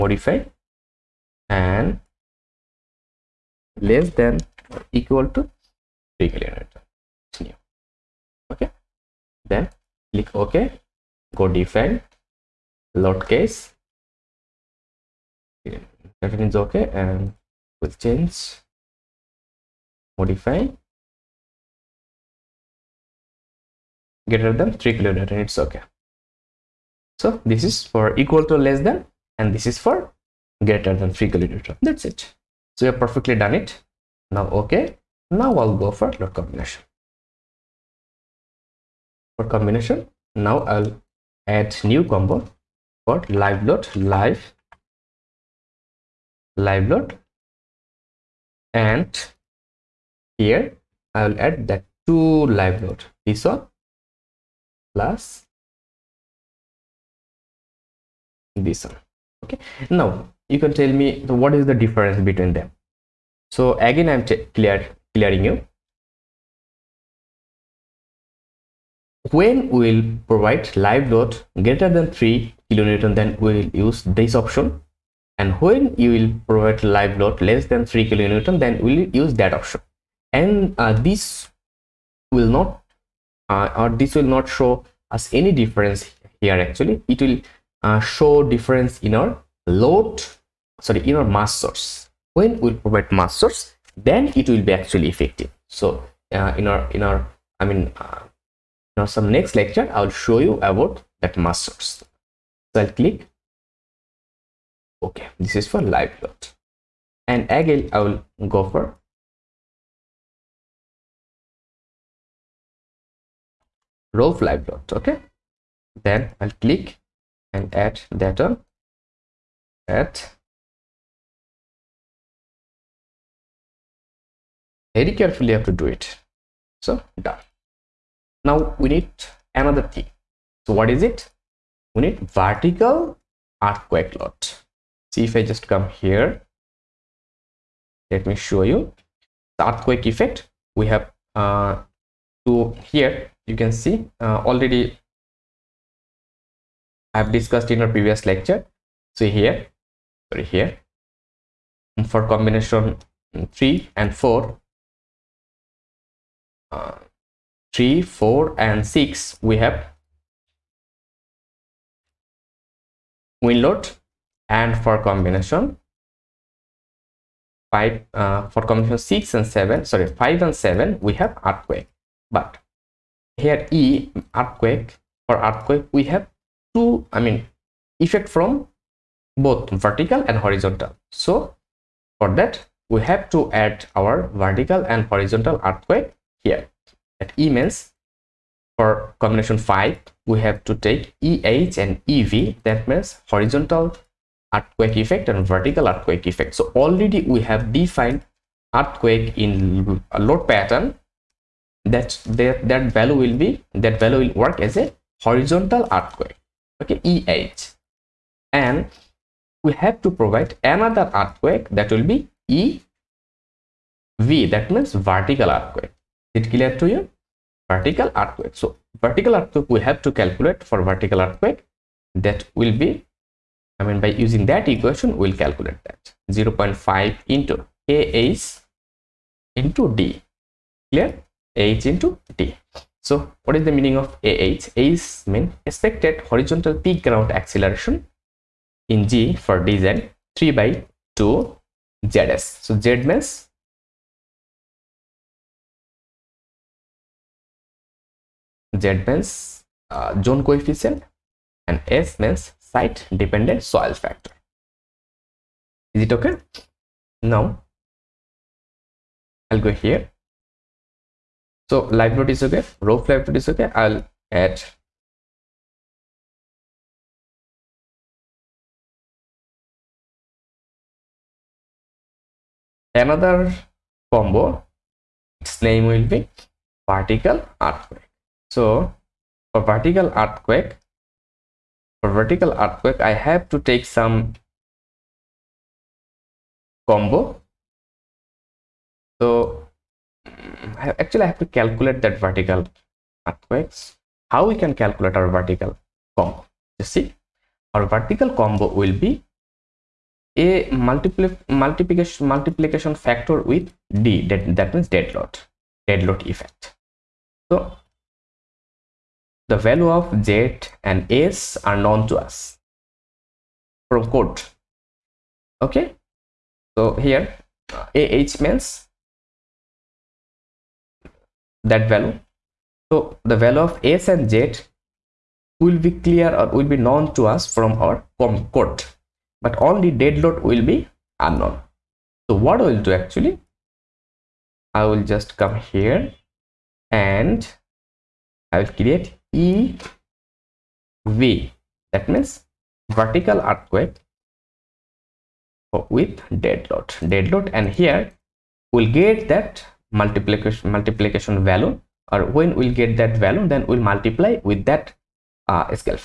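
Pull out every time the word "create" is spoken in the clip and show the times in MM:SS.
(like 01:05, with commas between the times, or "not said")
05:38.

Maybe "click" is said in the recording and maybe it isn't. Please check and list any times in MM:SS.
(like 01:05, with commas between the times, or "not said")
00:10, 01:43, 01:56.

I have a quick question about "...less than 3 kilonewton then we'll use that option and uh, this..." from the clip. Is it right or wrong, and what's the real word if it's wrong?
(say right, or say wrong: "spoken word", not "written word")
right.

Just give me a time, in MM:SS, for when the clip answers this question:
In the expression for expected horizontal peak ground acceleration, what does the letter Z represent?
04:10.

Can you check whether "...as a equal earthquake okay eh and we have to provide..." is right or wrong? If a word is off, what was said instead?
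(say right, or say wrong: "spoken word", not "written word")
wrong: "horizontal", not "equal".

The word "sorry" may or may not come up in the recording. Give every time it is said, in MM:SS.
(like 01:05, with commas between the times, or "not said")
01:30, 02:30, 02:49.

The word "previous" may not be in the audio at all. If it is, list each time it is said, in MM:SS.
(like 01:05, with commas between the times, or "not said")
02:27.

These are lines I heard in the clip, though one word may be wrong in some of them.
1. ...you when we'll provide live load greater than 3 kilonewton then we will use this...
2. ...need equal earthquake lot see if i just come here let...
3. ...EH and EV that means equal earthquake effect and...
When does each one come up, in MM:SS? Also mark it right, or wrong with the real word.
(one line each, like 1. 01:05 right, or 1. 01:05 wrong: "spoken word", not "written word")
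1. 01:05 right
2. 02:12 wrong: "vertical", not "equal"
3. 03:11 wrong: "horizontal", not "equal".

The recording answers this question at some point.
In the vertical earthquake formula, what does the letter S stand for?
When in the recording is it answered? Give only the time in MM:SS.
04:12.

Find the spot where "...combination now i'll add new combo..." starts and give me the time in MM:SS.
00:39.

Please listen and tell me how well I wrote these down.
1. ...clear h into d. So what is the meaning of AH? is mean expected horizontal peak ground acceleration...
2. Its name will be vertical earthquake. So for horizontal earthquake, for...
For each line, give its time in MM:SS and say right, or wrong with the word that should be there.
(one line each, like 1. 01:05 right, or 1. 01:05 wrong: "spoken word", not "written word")
1. 03:50 right
2. 04:35 wrong: "vertical", not "horizontal".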